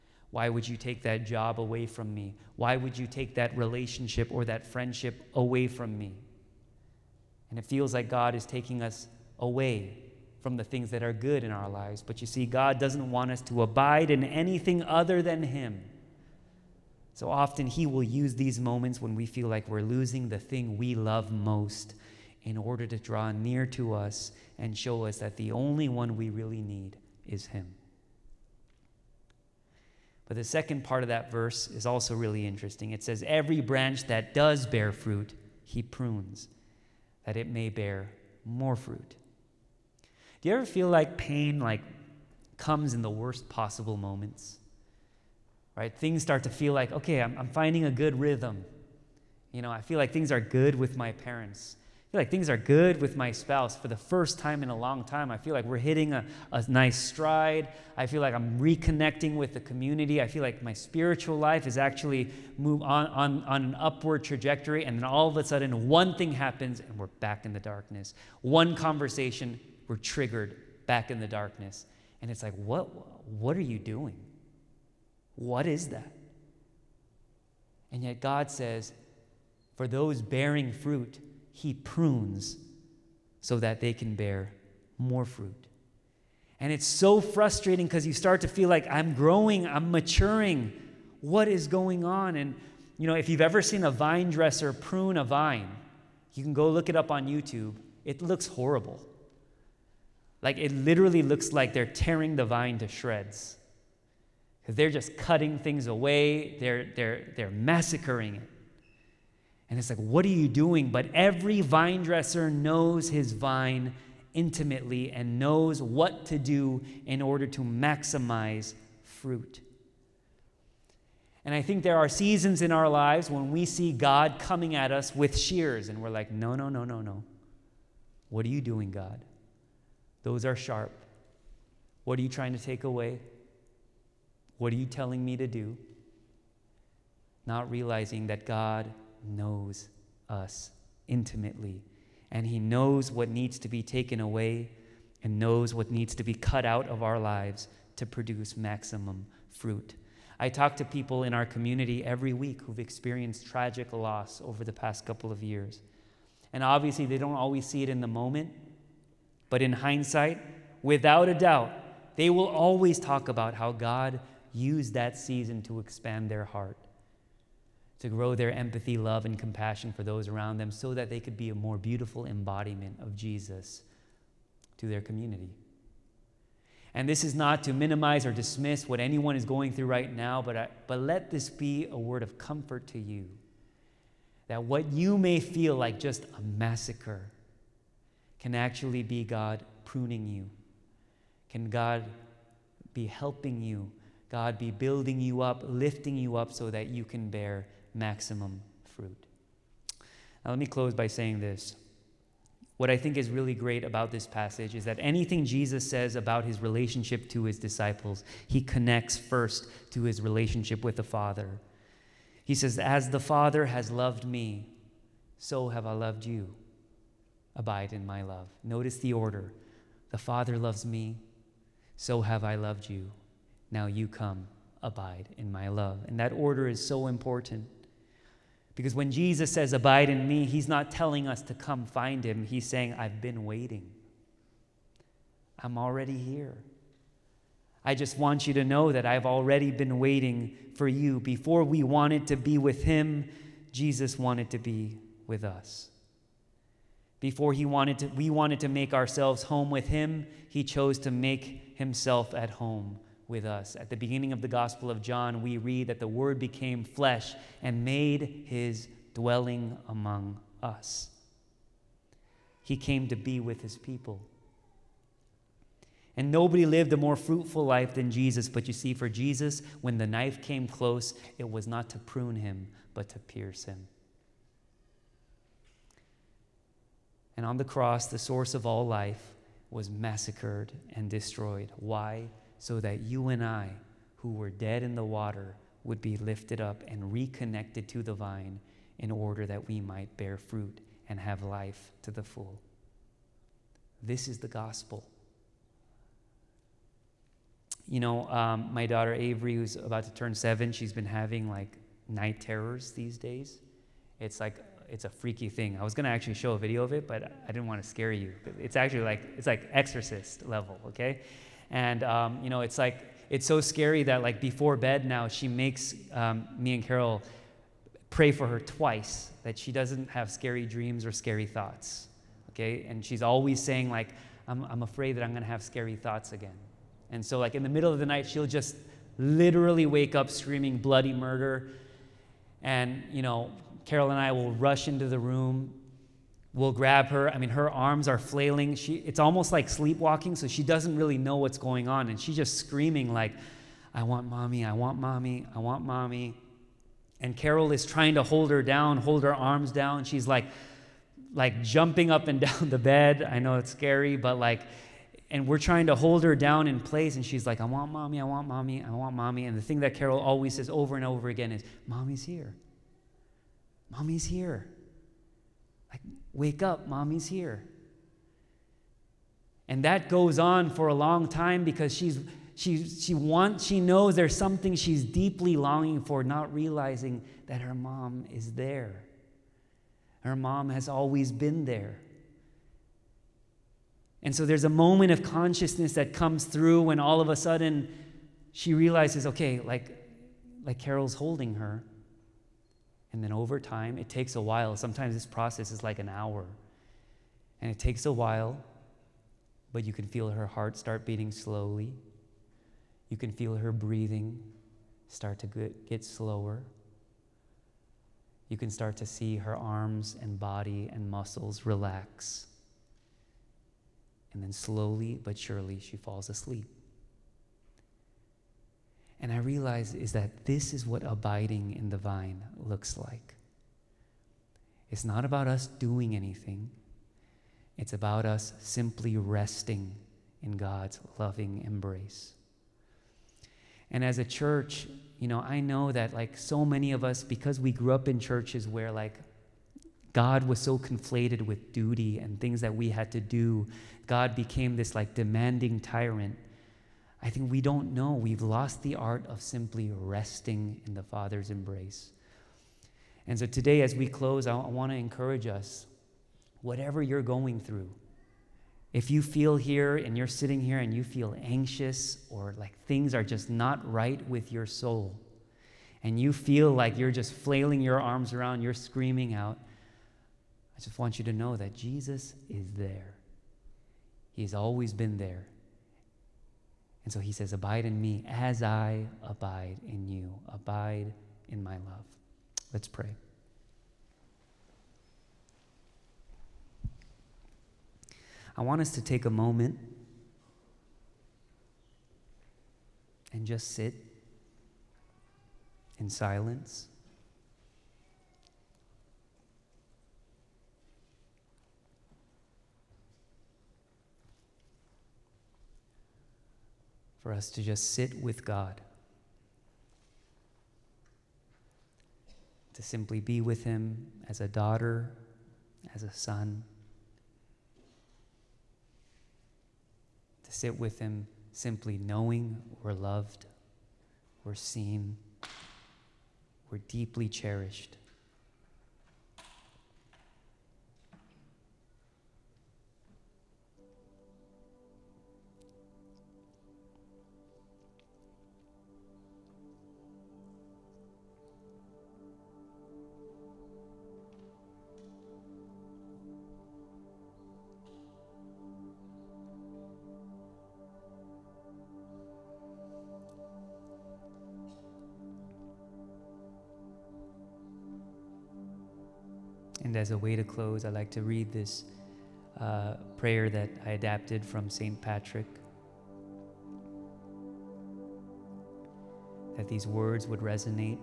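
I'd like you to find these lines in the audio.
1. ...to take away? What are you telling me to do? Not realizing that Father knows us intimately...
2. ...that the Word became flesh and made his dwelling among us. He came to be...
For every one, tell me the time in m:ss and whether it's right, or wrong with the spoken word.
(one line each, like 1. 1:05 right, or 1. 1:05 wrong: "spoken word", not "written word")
1. 2:12 wrong: "God", not "Father"
2. 4:15 right.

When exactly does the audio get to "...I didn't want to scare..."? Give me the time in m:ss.
5:07.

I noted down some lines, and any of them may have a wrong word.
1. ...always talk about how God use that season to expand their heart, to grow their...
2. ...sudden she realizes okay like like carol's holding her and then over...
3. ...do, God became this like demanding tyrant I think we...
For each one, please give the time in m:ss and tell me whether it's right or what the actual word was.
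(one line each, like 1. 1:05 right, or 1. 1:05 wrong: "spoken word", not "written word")
1. 2:42 right
2. 6:27 right
3. 7:23 right.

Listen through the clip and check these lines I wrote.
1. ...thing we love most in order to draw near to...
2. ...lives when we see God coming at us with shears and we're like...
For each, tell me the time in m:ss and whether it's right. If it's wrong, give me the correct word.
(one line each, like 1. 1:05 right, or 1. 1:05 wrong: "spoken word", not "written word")
1. 0:20 right
2. 2:02 right.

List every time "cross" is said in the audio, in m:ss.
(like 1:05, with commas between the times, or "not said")
4:37.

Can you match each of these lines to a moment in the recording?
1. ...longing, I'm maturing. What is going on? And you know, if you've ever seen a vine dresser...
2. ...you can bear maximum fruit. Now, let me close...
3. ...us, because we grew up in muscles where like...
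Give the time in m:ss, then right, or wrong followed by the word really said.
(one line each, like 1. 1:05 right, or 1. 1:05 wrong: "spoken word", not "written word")
1. 1:29 wrong: "growing", not "longing"
2. 3:16 right
3. 7:17 wrong: "churches", not "muscles".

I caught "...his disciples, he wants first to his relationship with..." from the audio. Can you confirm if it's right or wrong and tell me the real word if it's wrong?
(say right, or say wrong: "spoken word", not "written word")
wrong: "connects", not "wants".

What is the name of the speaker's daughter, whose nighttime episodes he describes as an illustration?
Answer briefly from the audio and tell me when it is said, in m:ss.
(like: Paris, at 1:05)
Avery, at 4:59.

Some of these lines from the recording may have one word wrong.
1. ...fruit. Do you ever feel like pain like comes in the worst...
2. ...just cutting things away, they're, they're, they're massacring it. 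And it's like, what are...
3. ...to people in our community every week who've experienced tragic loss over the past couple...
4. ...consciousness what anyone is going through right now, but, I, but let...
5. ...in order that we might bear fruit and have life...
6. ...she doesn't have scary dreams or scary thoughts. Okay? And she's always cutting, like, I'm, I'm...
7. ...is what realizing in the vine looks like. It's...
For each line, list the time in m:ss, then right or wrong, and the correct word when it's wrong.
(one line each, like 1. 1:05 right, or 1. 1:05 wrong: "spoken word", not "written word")
1. 0:38 right
2. 1:44 right
3. 2:30 right
4. 2:58 wrong: "dismiss", not "consciousness"
5. 4:48 right
6. 5:19 wrong: "saying", not "cutting"
7. 7:00 wrong: "abiding", not "realizing".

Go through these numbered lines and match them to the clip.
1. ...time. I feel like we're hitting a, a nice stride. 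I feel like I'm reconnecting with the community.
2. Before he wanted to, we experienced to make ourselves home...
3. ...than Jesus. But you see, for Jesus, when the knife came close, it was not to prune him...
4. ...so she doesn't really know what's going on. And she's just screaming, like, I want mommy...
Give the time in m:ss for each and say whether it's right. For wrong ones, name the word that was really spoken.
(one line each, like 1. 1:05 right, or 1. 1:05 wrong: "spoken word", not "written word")
1. 0:55 right
2. 4:07 wrong: "wanted", not "experienced"
3. 4:27 right
4. 5:40 right.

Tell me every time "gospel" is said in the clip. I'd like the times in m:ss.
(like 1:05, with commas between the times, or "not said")
4:14, 4:54.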